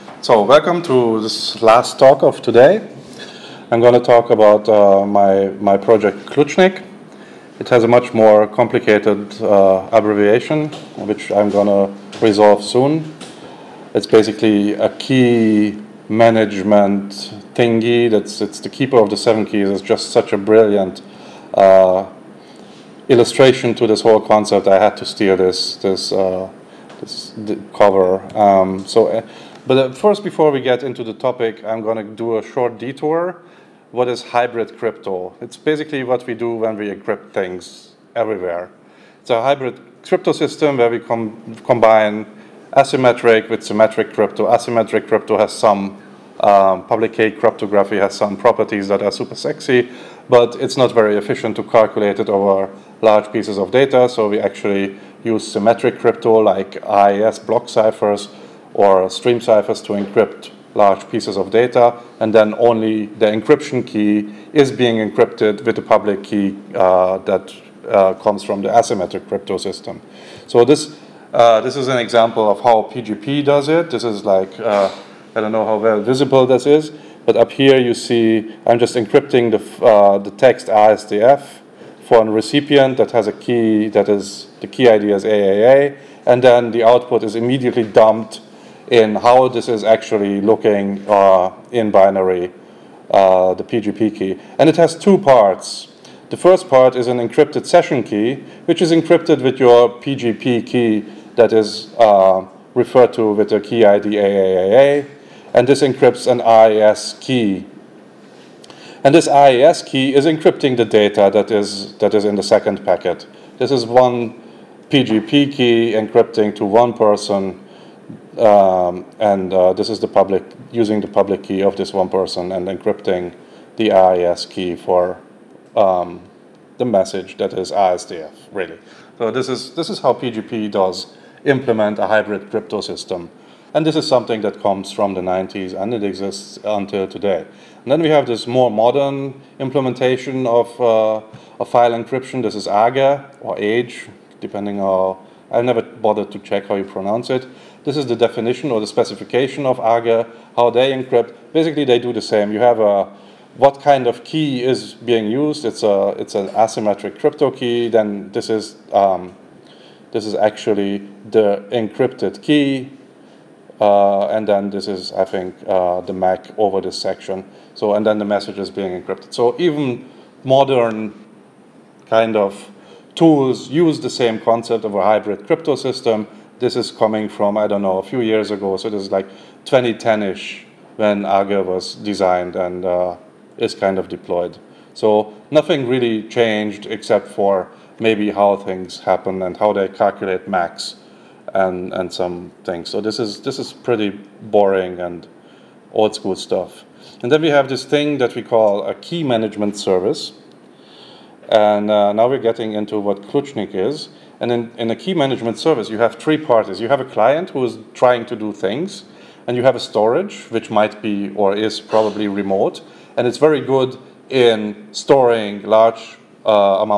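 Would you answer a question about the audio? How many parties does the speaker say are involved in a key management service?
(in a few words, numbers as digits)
3.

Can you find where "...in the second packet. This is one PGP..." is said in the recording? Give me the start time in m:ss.
1:52.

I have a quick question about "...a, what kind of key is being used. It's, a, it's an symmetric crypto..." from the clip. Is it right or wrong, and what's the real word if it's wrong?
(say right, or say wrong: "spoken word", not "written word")
wrong: "asymmetric", not "symmetric".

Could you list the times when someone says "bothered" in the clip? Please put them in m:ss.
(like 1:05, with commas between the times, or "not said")
2:25.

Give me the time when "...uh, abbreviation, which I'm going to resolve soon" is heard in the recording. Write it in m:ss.
0:09.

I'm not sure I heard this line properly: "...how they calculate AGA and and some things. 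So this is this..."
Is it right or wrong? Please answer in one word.
wrong.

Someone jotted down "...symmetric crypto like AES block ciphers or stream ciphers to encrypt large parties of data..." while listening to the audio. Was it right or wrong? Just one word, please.
wrong.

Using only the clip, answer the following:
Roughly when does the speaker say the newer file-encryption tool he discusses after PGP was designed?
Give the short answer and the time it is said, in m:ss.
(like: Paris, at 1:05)
2010-ish, at 2:59.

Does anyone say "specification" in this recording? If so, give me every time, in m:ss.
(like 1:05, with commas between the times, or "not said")
2:28.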